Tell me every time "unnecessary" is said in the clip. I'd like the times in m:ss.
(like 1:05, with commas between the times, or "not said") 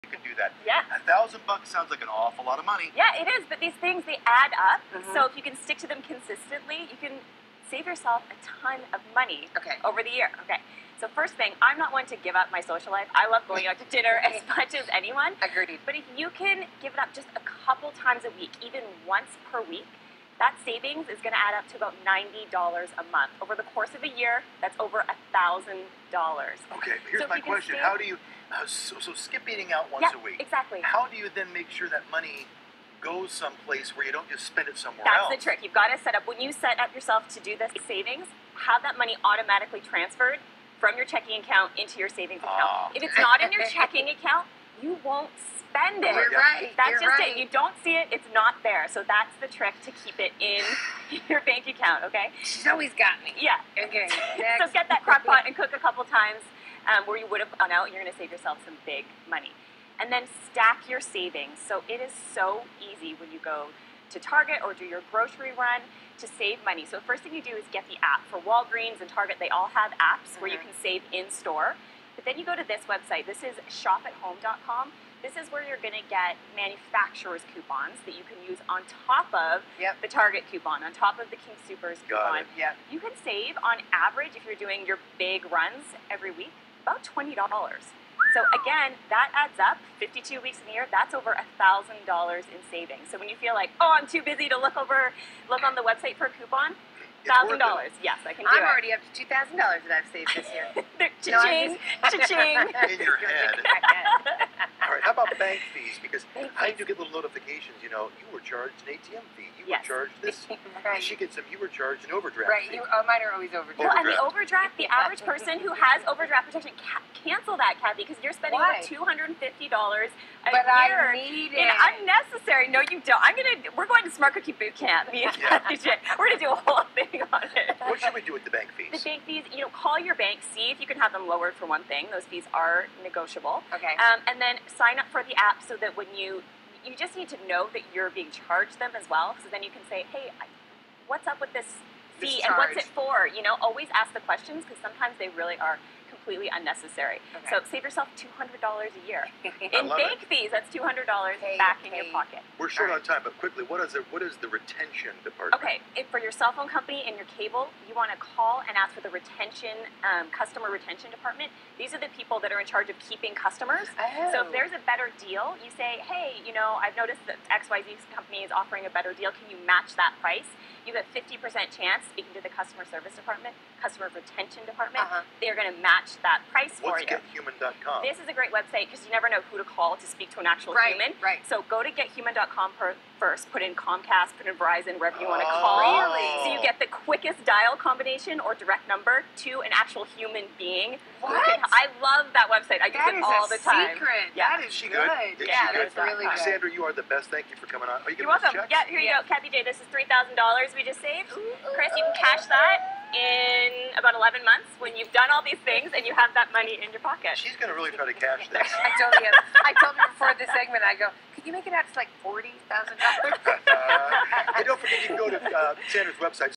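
2:01, 2:26.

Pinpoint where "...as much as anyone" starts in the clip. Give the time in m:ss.
0:14.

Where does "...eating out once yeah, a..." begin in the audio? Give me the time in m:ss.
0:29.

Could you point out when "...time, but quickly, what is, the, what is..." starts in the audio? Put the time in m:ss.
2:33.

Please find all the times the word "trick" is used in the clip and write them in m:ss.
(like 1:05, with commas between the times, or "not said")
0:35, 0:49.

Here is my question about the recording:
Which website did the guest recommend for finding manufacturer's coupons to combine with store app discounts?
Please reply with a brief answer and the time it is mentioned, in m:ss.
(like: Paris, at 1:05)
shopathome.com, at 1:13.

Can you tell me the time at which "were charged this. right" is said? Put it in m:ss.
1:49.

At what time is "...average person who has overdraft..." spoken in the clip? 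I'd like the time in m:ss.
1:54.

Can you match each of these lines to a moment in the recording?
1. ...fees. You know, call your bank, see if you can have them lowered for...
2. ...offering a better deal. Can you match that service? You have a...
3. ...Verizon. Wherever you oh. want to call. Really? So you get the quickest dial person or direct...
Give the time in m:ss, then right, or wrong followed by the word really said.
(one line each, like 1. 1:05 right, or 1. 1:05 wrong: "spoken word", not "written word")
1. 2:09 right
2. 2:48 wrong: "price", not "service"
3. 3:04 wrong: "combination", not "person".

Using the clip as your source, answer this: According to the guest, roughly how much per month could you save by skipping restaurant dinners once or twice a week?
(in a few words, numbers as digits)
$90.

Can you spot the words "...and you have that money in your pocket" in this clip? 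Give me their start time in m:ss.
3:25.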